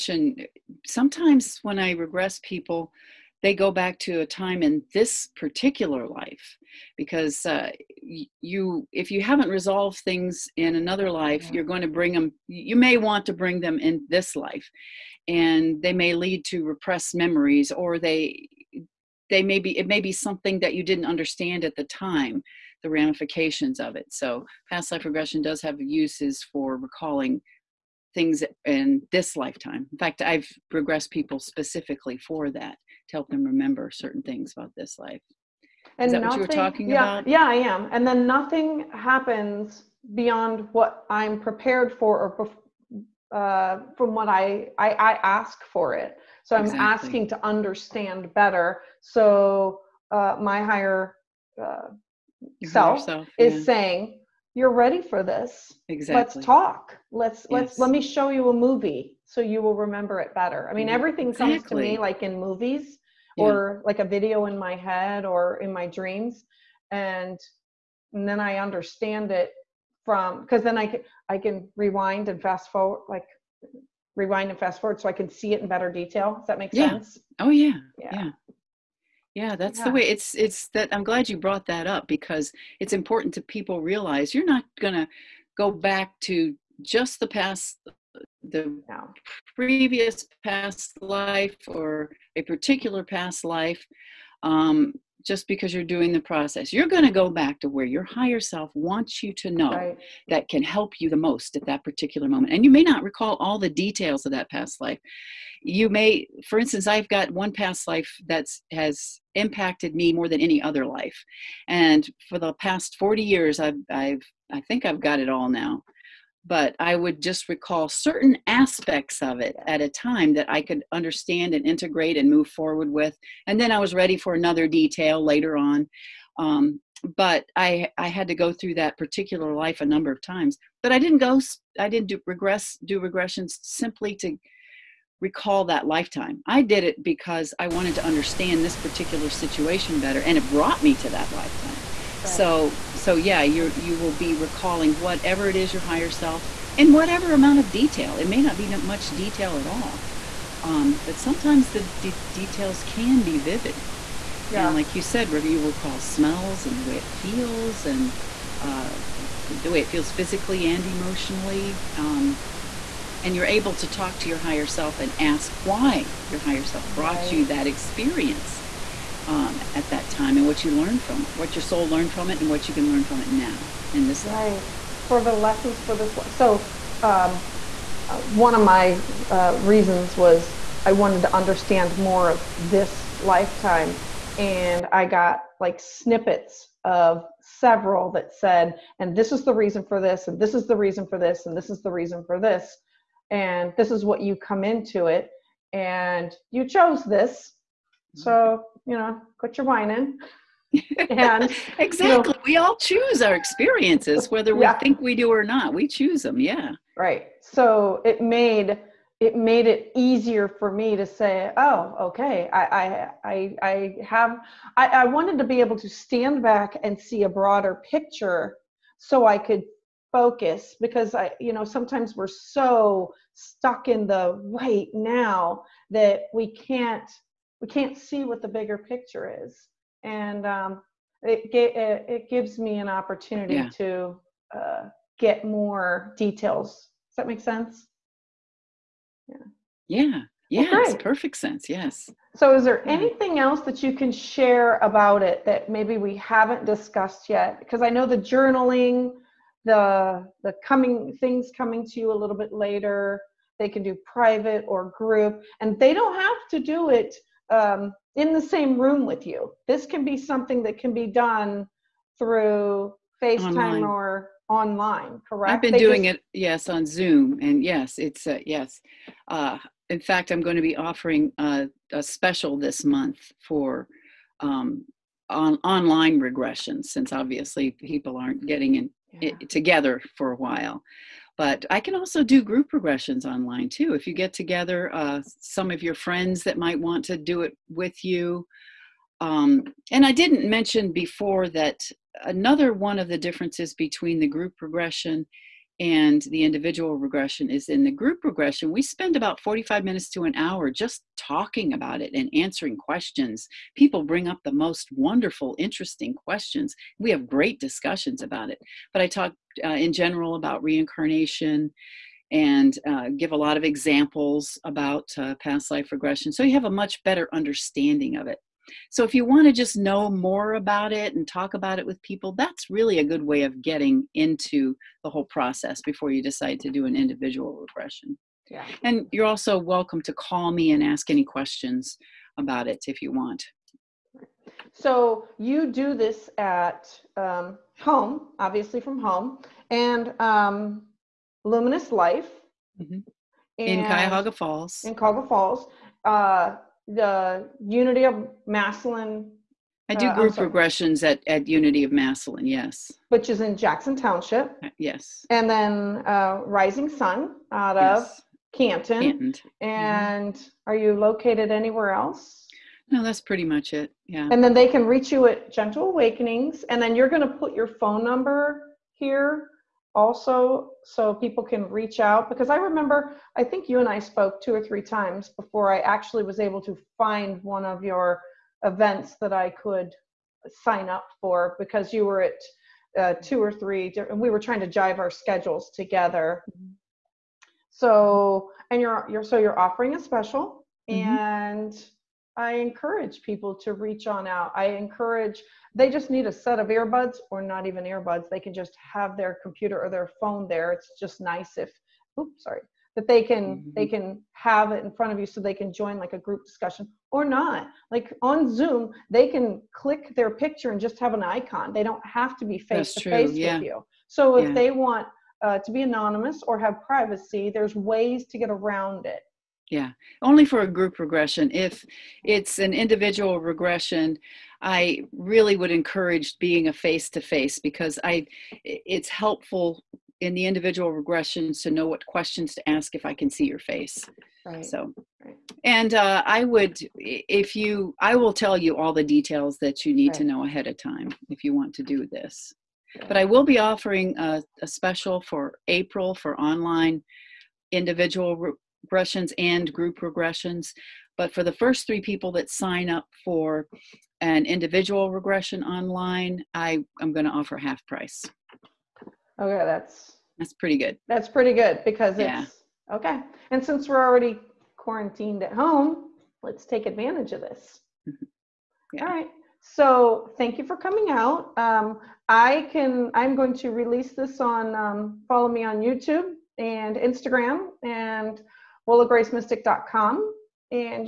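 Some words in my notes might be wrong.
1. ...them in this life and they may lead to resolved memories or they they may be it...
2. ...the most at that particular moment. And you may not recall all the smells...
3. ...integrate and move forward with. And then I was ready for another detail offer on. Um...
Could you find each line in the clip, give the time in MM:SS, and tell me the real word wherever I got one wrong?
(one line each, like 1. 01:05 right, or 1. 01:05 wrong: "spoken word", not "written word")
1. 00:13 wrong: "repressed", not "resolved"
2. 01:41 wrong: "details", not "smells"
3. 02:01 wrong: "later", not "offer".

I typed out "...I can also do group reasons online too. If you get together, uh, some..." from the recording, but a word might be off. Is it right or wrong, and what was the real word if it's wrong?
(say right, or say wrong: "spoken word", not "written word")
wrong: "progressions", not "reasons".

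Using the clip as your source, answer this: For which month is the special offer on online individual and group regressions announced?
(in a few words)
April.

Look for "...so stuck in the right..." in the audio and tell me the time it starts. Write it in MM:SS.
03:42.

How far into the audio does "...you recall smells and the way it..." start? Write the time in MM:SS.
02:35.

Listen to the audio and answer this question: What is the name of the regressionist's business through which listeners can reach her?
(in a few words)
Gentle Awakenings.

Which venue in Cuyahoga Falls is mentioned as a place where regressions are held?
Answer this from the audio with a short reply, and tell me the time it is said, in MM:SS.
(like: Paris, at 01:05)
Luminous Life, at 05:41.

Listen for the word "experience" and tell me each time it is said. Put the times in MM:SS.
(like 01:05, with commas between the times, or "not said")
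02:47, 03:23.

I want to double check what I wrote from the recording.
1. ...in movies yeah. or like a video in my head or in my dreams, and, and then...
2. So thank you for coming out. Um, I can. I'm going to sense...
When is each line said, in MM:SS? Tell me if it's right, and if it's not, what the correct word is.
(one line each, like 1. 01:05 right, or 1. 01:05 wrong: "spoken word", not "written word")
1. 01:02 right
2. 07:49 wrong: "release", not "sense".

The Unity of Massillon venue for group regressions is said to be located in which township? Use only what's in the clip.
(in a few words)
Jackson Township.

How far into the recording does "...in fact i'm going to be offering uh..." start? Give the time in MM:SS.
04:29.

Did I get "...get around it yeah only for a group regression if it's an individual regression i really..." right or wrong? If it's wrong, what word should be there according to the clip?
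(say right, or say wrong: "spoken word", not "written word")
right.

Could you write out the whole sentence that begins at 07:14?
so and uh, i would if you i will tell you all the details that you need right.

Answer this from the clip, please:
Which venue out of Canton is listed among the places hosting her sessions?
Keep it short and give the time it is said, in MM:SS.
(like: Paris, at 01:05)
Rising Sun, at 05:56.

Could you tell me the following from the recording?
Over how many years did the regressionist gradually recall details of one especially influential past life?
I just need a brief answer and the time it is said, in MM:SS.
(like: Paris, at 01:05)
40, at 01:52.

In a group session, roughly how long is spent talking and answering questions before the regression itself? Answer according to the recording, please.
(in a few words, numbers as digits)
45 minutes to an hour.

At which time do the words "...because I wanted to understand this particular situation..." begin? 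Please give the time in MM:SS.
02:17.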